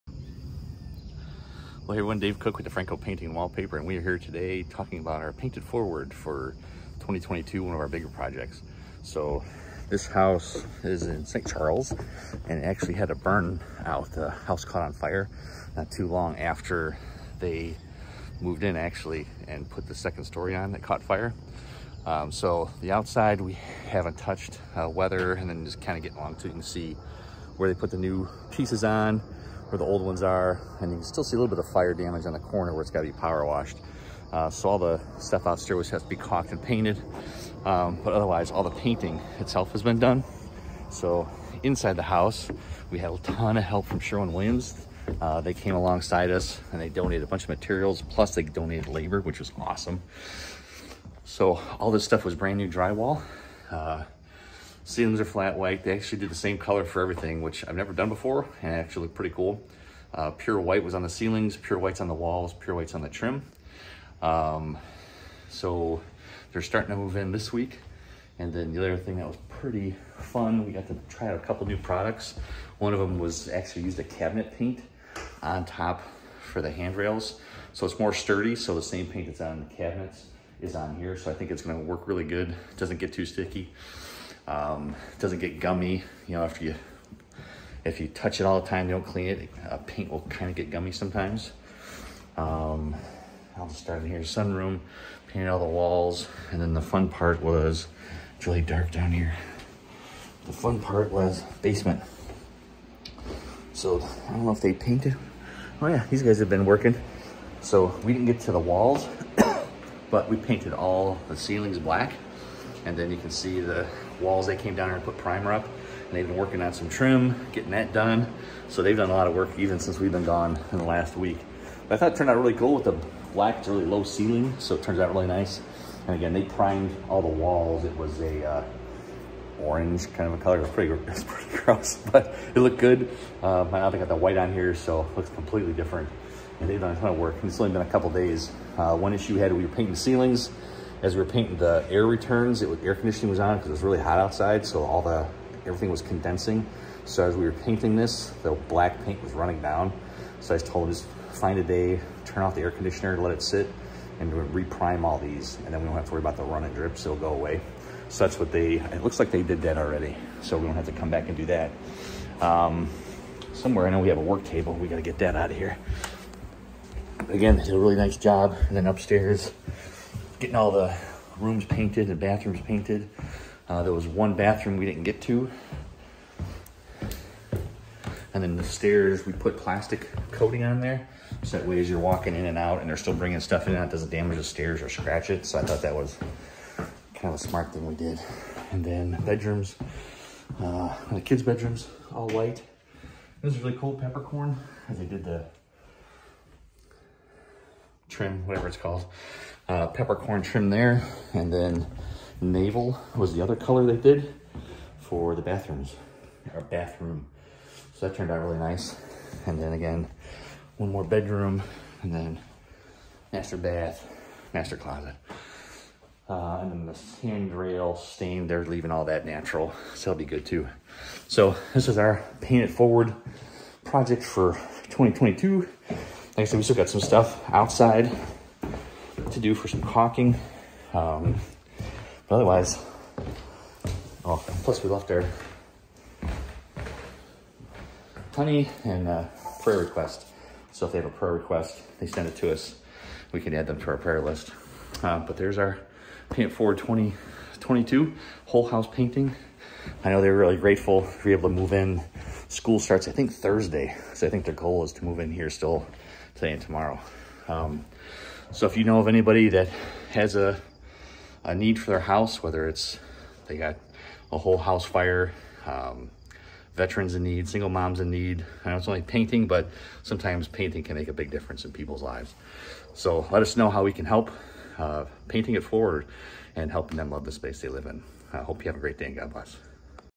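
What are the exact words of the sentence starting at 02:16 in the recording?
And they've done a ton of work.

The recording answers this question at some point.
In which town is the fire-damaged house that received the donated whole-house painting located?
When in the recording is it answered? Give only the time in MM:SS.
00:11.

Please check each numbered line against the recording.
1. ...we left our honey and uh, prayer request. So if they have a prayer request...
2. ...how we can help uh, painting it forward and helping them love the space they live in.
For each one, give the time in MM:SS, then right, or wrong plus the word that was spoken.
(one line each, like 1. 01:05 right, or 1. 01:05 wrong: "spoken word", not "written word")
1. 03:54 right
2. 04:33 right.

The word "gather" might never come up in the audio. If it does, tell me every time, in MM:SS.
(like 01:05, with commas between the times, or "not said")
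not said.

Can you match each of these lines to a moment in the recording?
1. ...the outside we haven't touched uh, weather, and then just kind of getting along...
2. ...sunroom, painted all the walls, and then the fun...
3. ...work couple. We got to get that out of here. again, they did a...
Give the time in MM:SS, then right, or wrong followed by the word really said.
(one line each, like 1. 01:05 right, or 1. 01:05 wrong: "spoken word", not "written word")
1. 00:22 right
2. 01:34 right
3. 02:44 wrong: "table", not "couple".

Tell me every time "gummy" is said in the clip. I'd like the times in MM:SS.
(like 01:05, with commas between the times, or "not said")
01:25, 01:30.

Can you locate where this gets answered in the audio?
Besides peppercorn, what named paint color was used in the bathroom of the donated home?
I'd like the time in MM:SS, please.
03:22.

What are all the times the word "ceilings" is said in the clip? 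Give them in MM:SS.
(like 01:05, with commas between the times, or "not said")
00:54, 01:01, 01:51, 02:04, 02:19.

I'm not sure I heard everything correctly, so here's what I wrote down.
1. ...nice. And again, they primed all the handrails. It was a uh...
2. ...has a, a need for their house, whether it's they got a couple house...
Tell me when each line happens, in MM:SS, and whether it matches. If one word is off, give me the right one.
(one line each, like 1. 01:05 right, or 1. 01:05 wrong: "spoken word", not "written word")
1. 02:05 wrong: "walls", not "handrails"
2. 04:20 wrong: "whole", not "couple".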